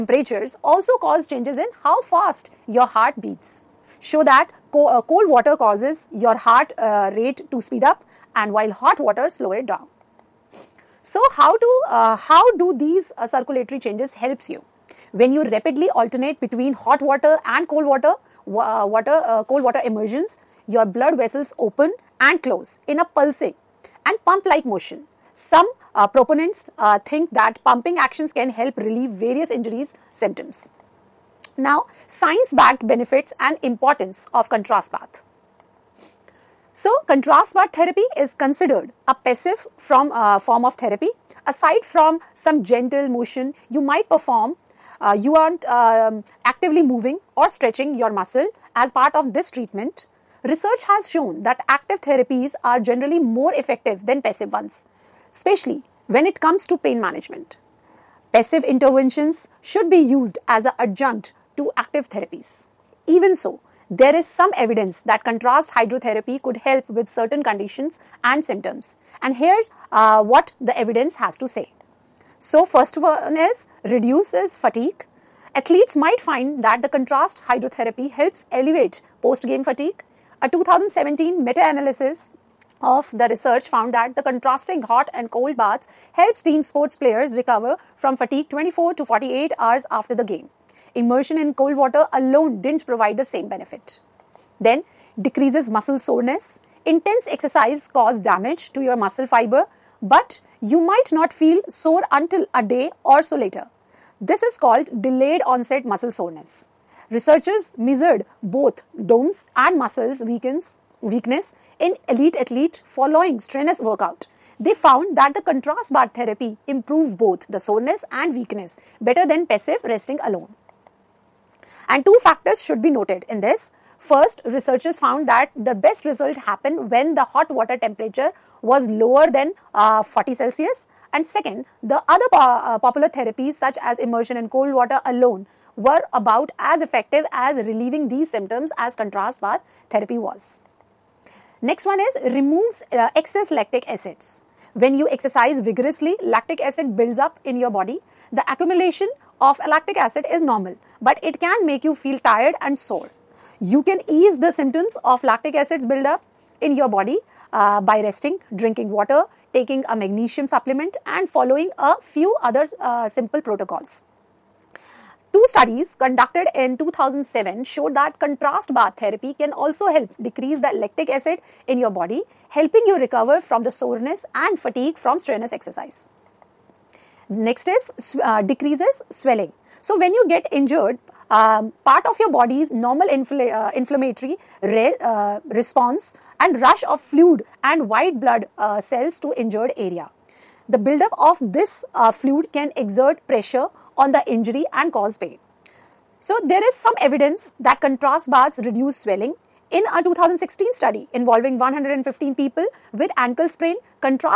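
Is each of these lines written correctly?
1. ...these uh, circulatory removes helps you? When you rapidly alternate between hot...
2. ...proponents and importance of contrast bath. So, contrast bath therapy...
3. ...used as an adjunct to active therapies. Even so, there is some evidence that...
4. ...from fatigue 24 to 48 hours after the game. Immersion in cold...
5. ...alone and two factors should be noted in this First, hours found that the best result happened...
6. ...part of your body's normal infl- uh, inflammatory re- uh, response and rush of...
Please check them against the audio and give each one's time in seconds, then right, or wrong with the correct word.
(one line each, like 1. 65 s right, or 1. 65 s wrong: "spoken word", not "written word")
1. 12 s wrong: "changes", not "removes"
2. 32 s wrong: "benefits", not "proponents"
3. 60 s right
4. 87 s right
5. 120 s wrong: "researchers", not "hours"
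6. 181 s right.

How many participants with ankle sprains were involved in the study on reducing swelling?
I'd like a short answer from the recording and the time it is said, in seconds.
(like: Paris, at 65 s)
115, at 201 s.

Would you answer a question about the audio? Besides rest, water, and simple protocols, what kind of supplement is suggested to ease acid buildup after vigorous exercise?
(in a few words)
magnesium.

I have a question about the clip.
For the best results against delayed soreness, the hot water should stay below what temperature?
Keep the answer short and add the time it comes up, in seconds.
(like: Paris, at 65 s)
40 Celsius, at 130 s.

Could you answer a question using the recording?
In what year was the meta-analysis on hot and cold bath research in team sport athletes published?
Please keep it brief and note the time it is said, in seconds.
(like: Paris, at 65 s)
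2017, at 80 s.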